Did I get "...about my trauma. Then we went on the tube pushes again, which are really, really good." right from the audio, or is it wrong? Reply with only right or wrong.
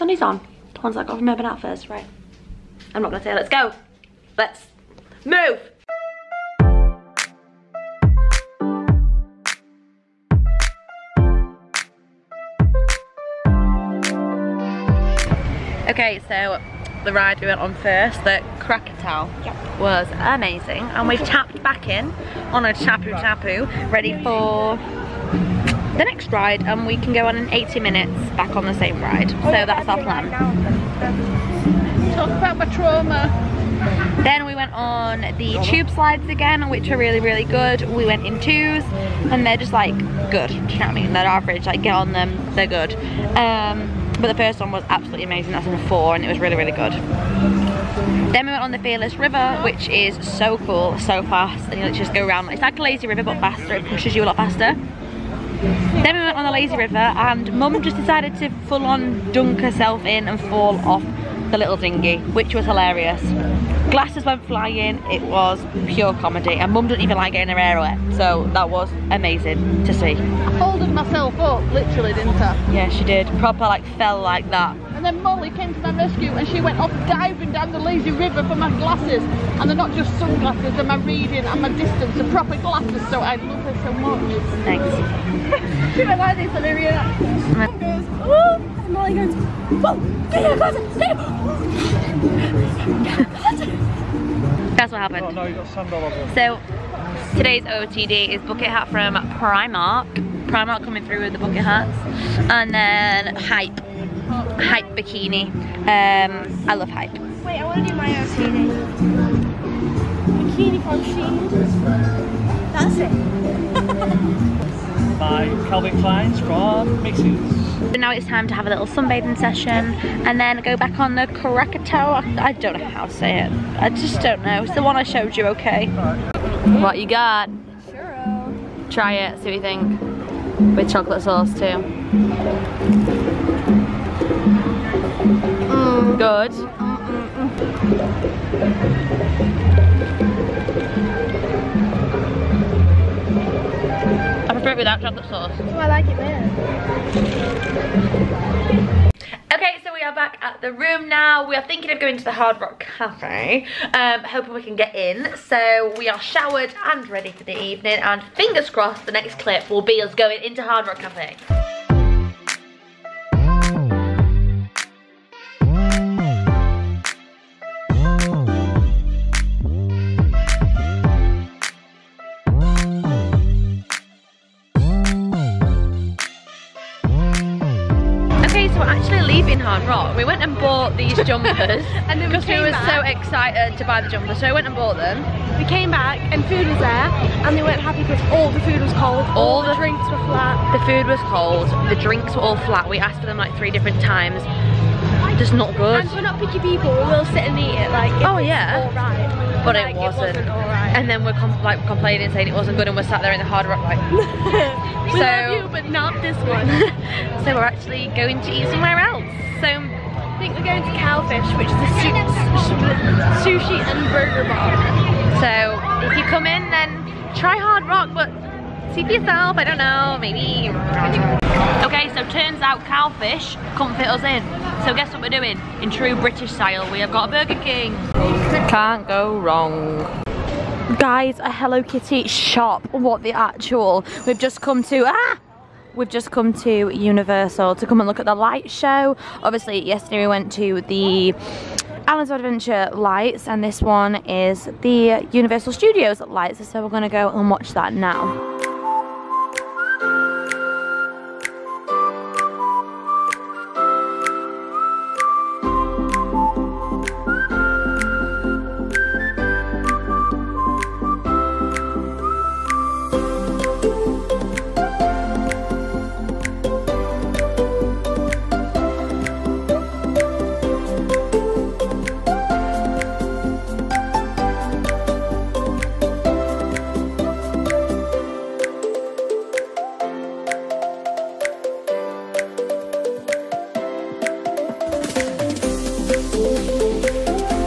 wrong.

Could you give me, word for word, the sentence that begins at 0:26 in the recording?
And we can go on in 80 minutes back on the same ride.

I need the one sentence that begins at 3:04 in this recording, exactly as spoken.
So we went and bought them.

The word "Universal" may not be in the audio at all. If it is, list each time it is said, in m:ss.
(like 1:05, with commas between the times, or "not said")
3:56, 4:05.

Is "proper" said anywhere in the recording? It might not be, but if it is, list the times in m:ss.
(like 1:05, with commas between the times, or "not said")
1:13, 1:22.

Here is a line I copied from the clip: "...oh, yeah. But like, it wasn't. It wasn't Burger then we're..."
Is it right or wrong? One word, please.
wrong.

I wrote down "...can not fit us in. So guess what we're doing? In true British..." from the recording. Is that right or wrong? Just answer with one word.
right.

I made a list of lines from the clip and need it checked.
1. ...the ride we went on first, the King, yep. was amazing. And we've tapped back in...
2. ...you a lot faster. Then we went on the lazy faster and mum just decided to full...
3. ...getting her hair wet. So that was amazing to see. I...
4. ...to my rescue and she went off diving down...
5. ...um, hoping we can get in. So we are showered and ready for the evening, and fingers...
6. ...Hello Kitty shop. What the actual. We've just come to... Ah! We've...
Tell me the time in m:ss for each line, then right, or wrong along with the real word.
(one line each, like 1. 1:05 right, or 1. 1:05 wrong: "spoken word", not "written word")
1. 0:17 wrong: "Krakatoa", not "King"
2. 0:54 wrong: "river", not "faster"
3. 1:07 right
4. 1:15 right
5. 2:33 right
6. 3:51 right.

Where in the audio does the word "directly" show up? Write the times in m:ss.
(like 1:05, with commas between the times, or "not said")
not said.